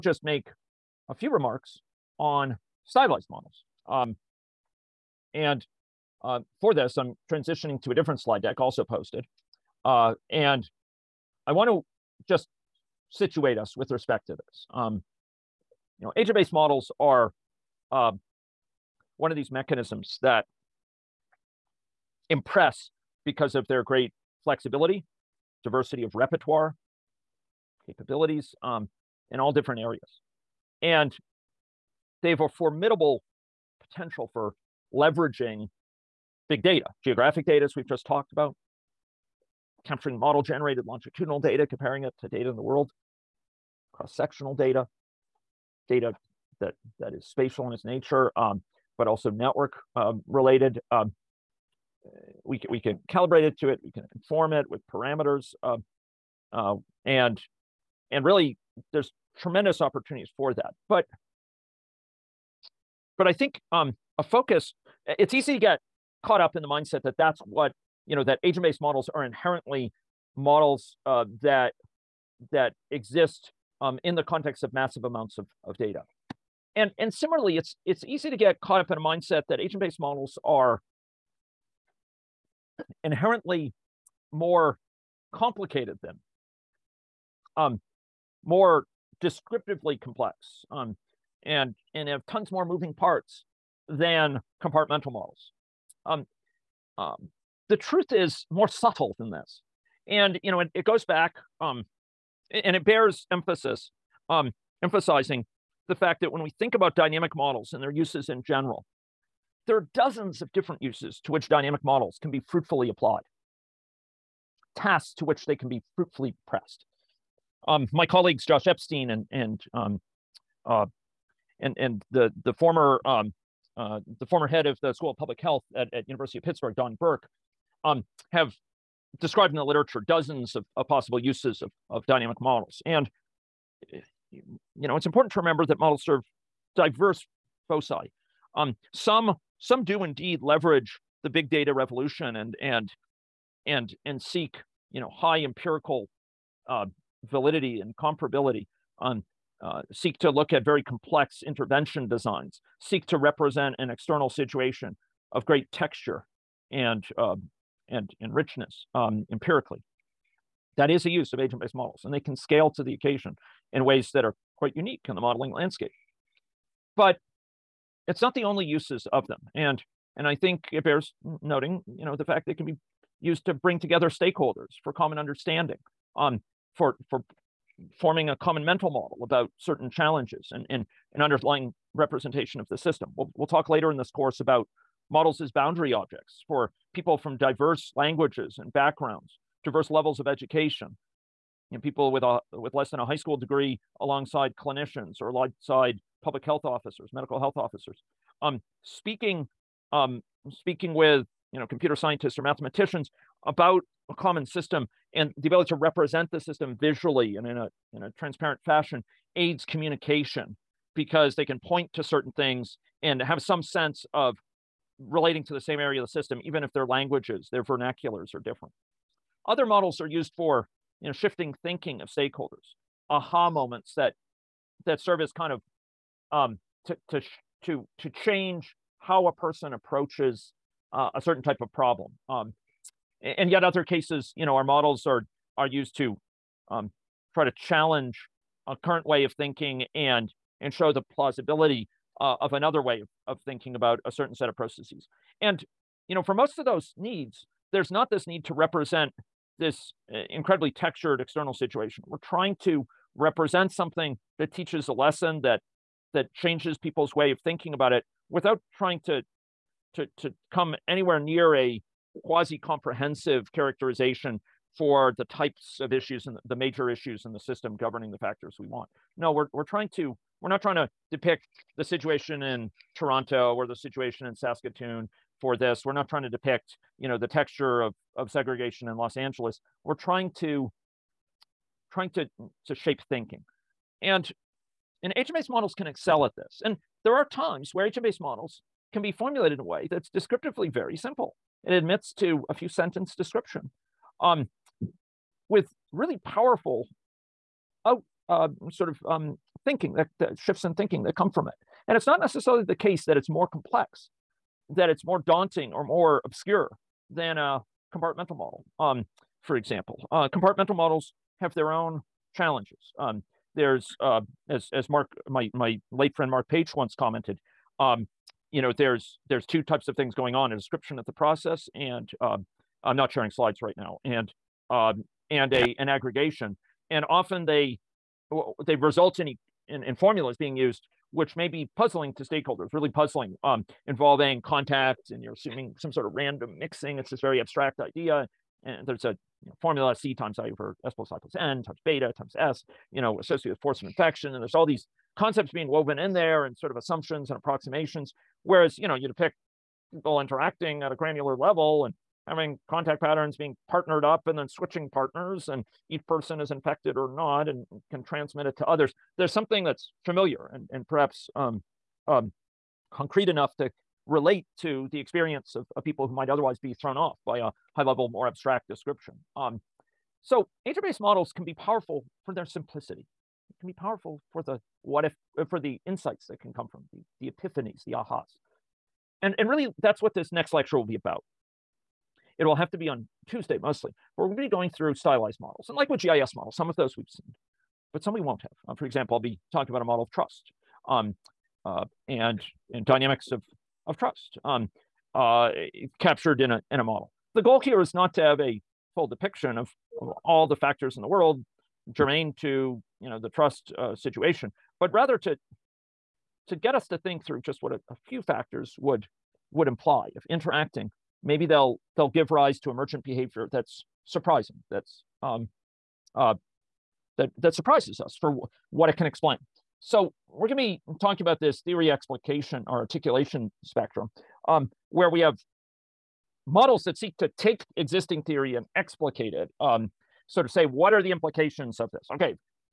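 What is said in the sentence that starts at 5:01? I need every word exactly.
And it's not necessarily the case that it's more complex, that it's more daunting or more obscure than a compartmental model.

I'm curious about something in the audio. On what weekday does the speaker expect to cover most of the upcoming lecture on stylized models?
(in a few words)
Tuesday.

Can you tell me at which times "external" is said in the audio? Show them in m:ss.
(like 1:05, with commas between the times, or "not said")
2:33, 4:11.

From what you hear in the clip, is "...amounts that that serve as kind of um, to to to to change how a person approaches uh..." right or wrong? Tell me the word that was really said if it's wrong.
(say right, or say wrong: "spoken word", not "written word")
wrong: "moments", not "amounts".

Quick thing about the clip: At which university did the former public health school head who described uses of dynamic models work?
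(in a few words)
University of Pittsburgh.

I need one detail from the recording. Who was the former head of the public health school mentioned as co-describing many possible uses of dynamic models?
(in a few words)
Don Burke.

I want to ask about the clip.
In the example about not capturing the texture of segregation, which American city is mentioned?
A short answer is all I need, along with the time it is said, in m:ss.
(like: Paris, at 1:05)
Los Angeles, at 4:38.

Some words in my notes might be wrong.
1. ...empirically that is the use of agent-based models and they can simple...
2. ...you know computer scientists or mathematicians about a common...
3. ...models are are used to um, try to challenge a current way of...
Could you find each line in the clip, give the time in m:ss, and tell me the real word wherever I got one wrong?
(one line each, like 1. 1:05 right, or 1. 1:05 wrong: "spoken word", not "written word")
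1. 2:39 wrong: "scale", not "simple"
2. 3:21 right
3. 3:54 right.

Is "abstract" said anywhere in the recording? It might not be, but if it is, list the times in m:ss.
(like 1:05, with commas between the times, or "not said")
5:37, 6:08.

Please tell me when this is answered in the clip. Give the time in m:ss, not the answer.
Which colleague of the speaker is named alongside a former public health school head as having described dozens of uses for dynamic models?
1:58.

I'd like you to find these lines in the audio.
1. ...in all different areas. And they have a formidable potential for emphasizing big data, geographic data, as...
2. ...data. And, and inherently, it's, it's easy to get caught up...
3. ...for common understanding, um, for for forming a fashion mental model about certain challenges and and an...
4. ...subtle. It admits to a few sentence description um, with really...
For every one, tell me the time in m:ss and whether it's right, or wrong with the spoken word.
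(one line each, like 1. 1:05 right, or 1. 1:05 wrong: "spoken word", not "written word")
1. 0:29 wrong: "leveraging", not "emphasizing"
2. 1:15 wrong: "similarly", not "inherently"
3. 2:54 wrong: "common", not "fashion"
4. 4:50 wrong: "simple", not "subtle".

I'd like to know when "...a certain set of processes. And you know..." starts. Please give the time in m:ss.
4:04.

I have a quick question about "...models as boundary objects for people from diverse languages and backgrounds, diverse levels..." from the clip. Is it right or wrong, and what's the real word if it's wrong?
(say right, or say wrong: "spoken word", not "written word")
right.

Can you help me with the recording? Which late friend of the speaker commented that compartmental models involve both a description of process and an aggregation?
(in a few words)
Mark Page.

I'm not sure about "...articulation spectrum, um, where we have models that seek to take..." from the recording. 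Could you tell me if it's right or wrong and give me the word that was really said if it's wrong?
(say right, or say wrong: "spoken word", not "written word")
right.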